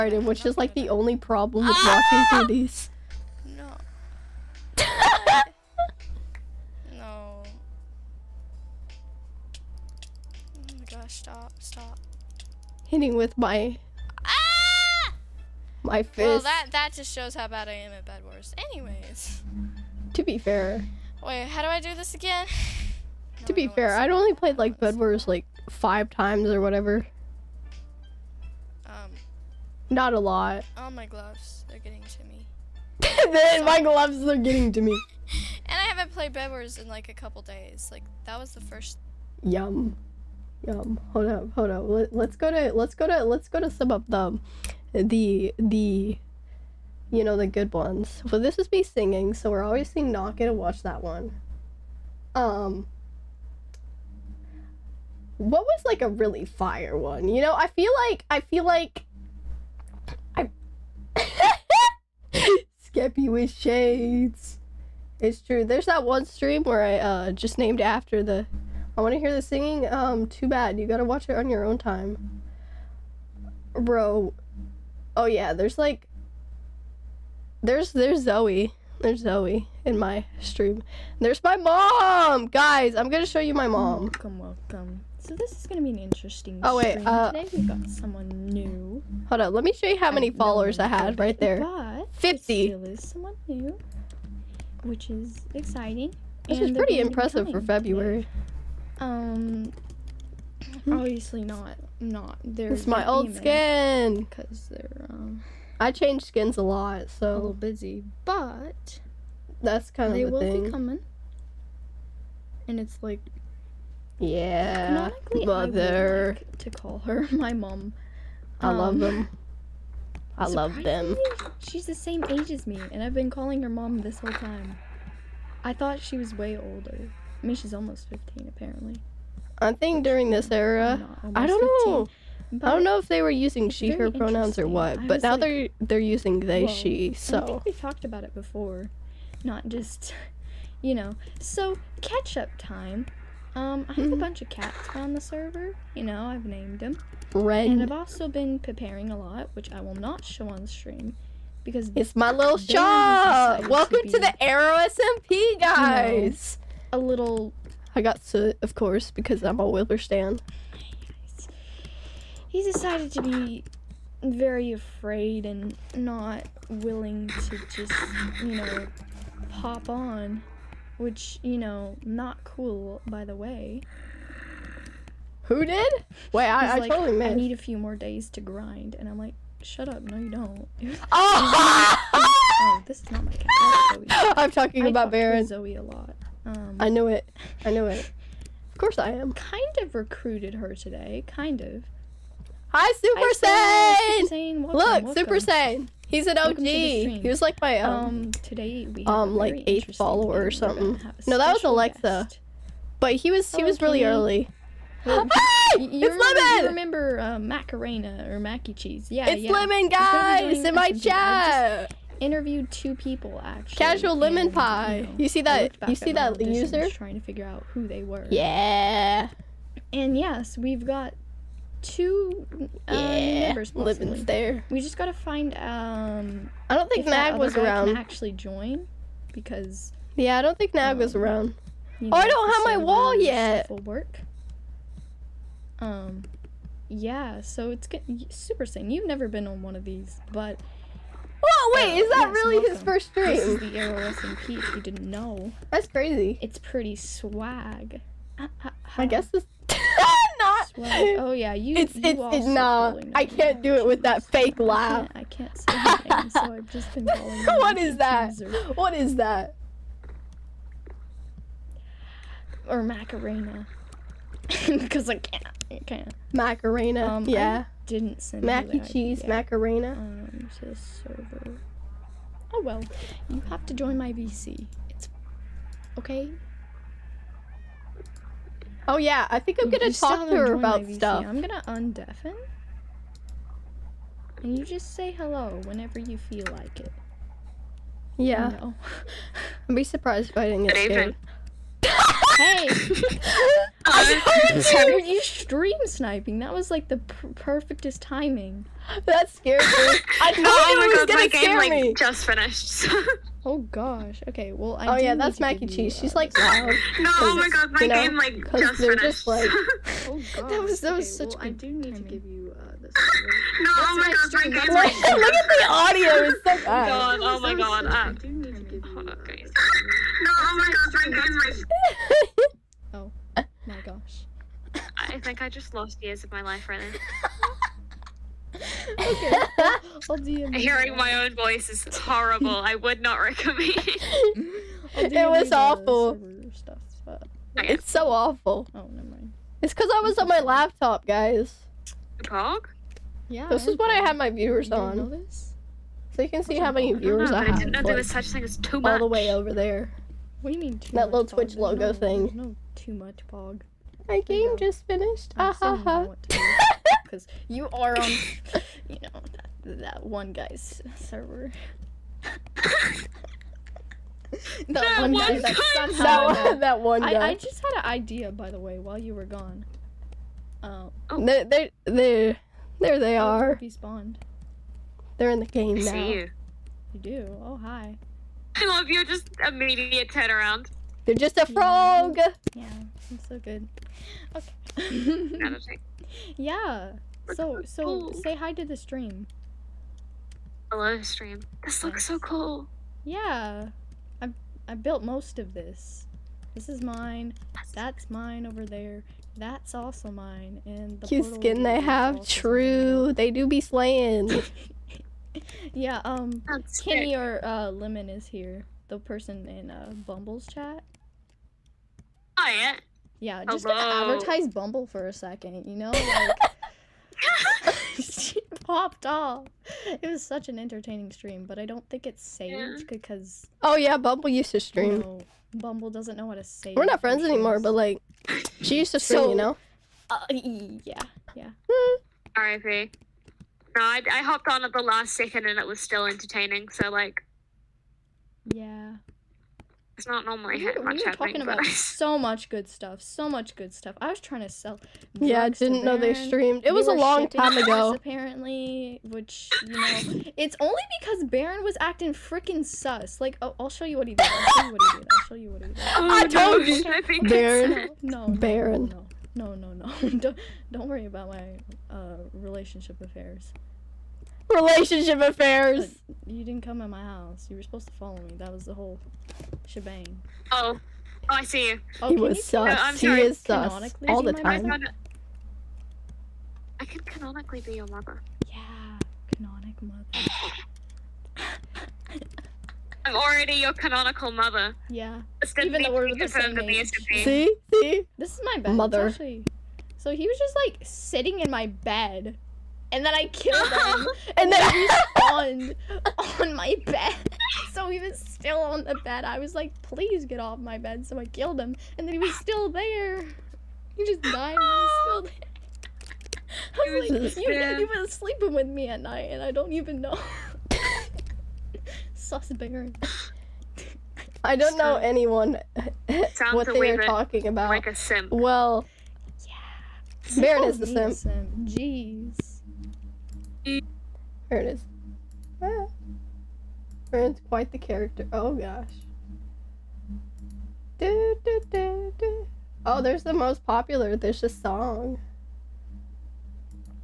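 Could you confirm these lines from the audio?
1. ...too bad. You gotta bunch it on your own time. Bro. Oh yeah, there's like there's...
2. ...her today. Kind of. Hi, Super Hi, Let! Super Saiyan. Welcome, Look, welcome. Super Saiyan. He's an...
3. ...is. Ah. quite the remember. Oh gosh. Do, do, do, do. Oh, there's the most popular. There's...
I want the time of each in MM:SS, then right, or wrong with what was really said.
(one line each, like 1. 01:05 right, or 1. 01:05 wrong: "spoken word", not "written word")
1. 01:10 wrong: "watch", not "bunch"
2. 03:10 wrong: "Saiyan", not "Let"
3. 08:44 wrong: "character", not "remember".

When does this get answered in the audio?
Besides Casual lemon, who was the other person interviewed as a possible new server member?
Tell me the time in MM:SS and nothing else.
03:34.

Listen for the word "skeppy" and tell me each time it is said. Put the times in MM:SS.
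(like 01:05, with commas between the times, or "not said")
01:02.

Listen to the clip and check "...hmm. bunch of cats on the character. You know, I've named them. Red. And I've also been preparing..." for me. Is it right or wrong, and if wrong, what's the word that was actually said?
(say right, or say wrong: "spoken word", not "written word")
wrong: "server", not "character".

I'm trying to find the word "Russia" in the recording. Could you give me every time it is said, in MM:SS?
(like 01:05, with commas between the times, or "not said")
not said.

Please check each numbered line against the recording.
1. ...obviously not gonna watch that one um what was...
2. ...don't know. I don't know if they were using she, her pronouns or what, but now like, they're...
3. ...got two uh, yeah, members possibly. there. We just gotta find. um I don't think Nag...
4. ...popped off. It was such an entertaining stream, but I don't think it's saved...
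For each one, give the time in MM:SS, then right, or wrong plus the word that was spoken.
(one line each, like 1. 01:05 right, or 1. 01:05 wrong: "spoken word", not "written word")
1. 00:49 right
2. 02:11 right
3. 03:40 right
4. 06:58 right.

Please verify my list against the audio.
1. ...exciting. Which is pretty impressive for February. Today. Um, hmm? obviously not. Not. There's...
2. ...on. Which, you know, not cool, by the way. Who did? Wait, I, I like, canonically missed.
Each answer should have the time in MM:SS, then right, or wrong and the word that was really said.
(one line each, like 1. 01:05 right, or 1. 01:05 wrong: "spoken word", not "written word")
1. 01:35 right
2. 02:49 wrong: "totally", not "canonically".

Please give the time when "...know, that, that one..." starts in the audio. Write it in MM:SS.
05:59.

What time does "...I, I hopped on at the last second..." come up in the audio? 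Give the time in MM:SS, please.
07:13.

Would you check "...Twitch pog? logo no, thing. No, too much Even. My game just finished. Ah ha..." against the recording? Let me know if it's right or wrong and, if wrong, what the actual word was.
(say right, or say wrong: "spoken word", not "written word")
wrong: "Pog", not "Even".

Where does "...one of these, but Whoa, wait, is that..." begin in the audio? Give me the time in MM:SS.
03:59.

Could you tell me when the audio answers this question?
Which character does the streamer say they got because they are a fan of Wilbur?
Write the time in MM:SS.
02:38.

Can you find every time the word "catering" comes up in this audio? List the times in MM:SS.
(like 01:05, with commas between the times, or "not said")
not said.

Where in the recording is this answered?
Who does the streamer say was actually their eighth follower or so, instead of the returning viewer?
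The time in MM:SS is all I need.
03:21.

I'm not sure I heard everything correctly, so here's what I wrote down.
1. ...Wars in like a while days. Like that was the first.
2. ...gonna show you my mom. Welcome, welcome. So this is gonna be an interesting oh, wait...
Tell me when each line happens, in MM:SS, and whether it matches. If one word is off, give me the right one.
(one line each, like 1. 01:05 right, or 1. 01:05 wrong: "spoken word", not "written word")
1. 00:36 wrong: "couple", not "while"
2. 01:23 right.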